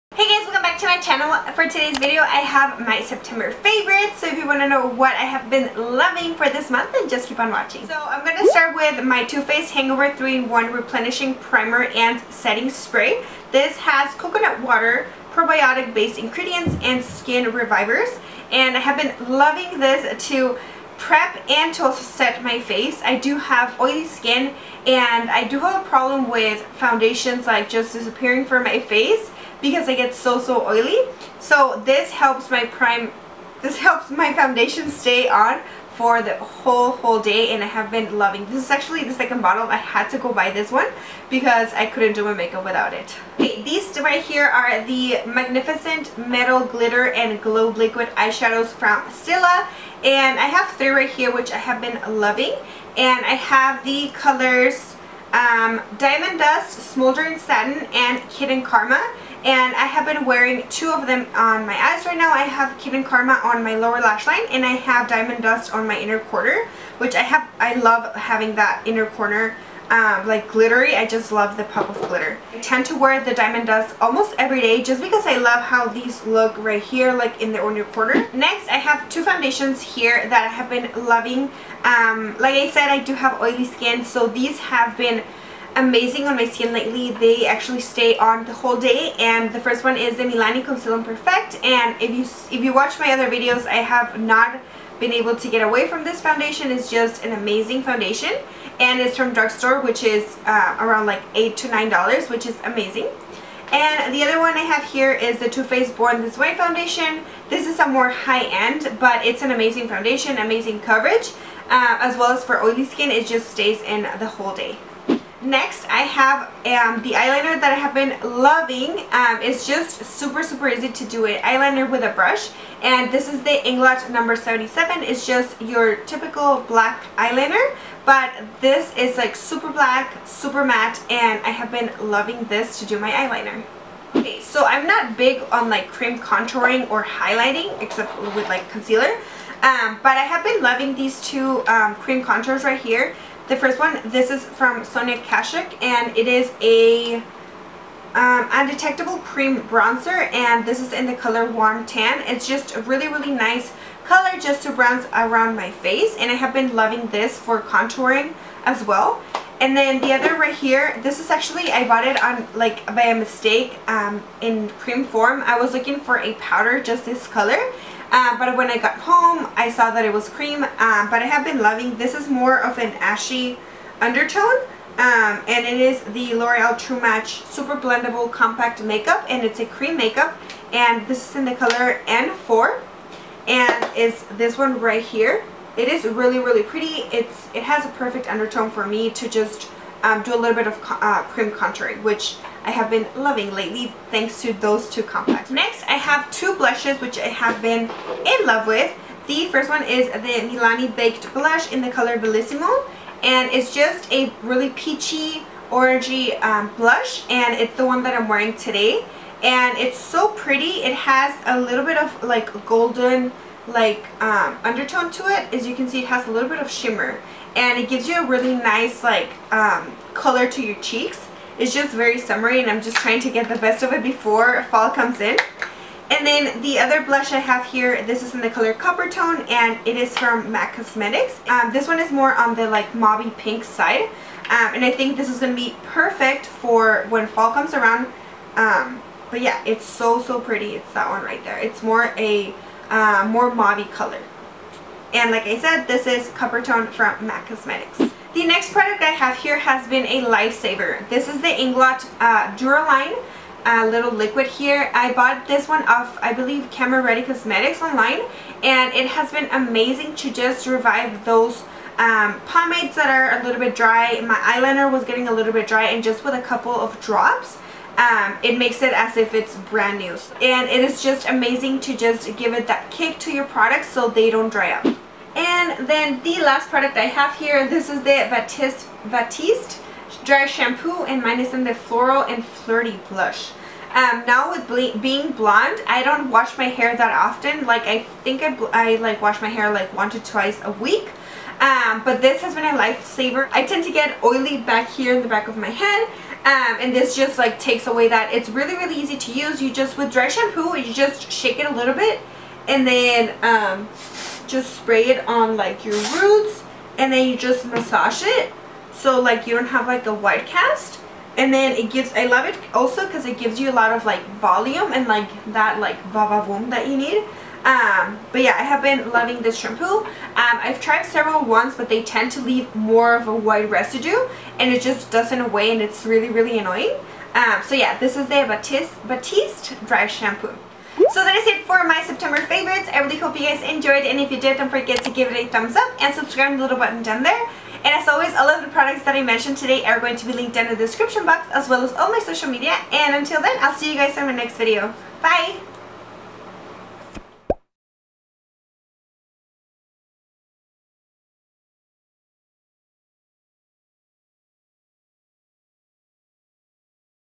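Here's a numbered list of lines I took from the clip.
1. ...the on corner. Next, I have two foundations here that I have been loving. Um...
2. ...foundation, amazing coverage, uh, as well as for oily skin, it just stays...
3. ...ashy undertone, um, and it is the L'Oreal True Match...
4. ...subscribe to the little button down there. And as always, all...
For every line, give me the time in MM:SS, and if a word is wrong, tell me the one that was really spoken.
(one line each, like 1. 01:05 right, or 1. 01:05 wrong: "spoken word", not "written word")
1. 01:17 wrong: "quarter", not "corner"
2. 01:49 right
3. 02:52 right
4. 05:36 right.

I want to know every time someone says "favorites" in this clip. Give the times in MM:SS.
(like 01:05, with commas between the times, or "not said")
00:03, 05:32.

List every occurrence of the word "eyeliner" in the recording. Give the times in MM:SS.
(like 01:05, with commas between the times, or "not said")
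01:57, 02:01, 02:07, 02:13, 04:24.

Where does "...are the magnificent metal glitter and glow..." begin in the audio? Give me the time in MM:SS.
00:44.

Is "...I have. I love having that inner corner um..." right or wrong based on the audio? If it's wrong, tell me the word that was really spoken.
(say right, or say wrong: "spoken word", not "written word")
right.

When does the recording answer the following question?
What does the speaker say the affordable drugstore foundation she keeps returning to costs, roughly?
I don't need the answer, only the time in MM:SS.
01:41.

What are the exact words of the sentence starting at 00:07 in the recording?
So I'm going to start with my Too Faced Hangover 3-in-1 Replenishing Primer and Setting Spray.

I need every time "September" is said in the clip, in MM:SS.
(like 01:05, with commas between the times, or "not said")
00:03, 05:32.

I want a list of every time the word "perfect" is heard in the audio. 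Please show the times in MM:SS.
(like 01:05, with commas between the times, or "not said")
01:31, 03:07, 03:55.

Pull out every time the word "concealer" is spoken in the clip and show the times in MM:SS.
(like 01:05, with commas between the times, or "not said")
01:30, 02:18.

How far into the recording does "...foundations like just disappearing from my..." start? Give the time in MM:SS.
00:26.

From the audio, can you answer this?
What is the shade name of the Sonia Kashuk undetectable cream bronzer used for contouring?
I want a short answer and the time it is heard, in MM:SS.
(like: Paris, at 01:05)
Warm Tan, at 02:31.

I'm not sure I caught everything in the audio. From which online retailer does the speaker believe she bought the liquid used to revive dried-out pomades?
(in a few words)
Camera Ready Cosmetics.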